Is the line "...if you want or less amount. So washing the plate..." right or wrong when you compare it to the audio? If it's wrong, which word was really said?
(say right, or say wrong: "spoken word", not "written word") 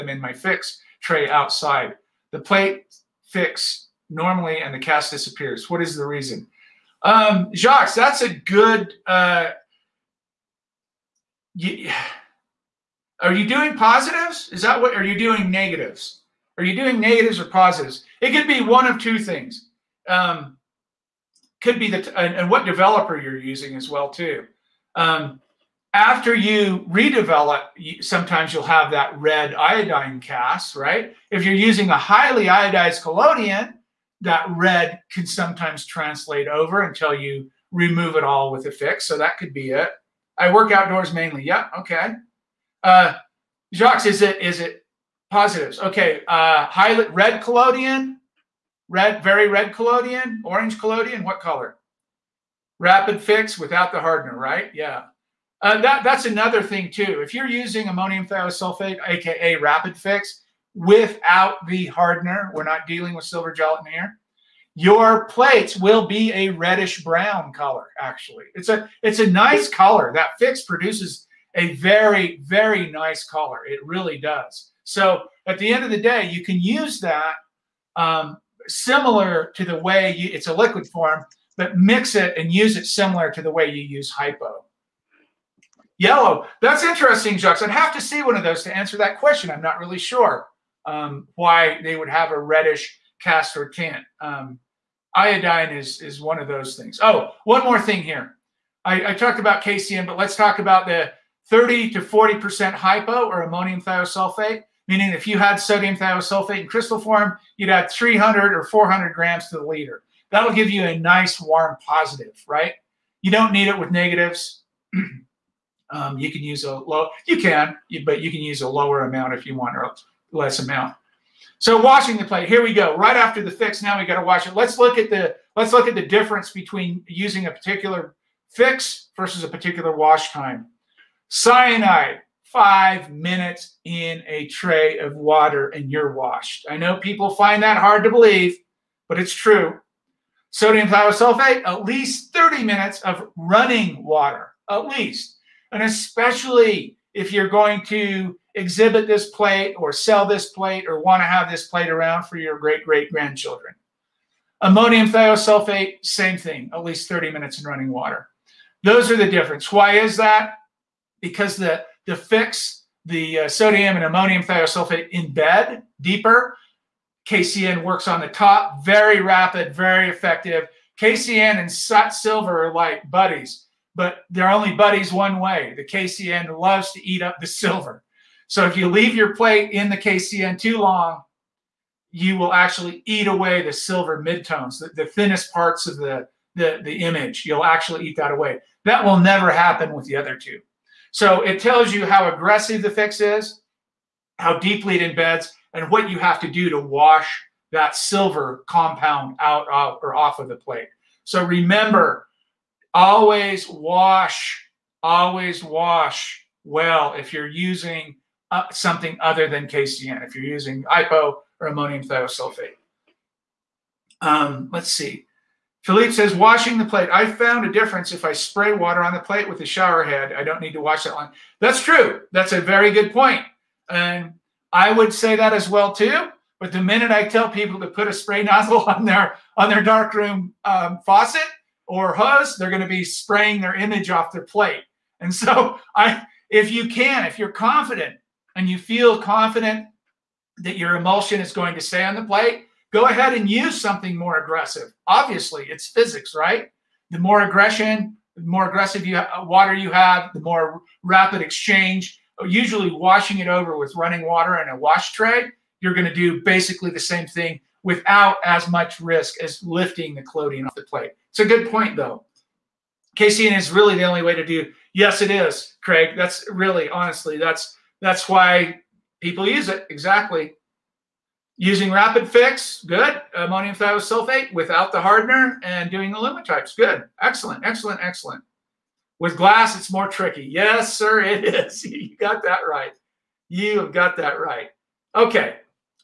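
right.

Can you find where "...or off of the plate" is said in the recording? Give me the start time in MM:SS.
03:20.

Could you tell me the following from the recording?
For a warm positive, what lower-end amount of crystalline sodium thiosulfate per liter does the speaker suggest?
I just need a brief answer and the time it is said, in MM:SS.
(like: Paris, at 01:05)
300, at 01:47.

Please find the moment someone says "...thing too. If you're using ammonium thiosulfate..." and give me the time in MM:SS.
00:56.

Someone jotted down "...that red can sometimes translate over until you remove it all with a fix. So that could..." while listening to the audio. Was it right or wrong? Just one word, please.
right.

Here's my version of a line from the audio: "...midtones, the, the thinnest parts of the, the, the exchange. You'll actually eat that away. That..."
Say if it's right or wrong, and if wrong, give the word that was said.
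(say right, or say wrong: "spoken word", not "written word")
wrong: "image", not "exchange".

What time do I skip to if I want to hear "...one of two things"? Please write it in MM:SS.
00:18.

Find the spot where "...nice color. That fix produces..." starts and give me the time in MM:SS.
01:09.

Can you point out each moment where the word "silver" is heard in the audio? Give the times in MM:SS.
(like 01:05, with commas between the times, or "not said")
01:03, 02:52, 02:57, 03:03, 03:17.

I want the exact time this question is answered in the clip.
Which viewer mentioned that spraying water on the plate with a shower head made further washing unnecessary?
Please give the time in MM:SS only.
03:35.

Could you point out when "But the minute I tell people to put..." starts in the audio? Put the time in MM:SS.
03:46.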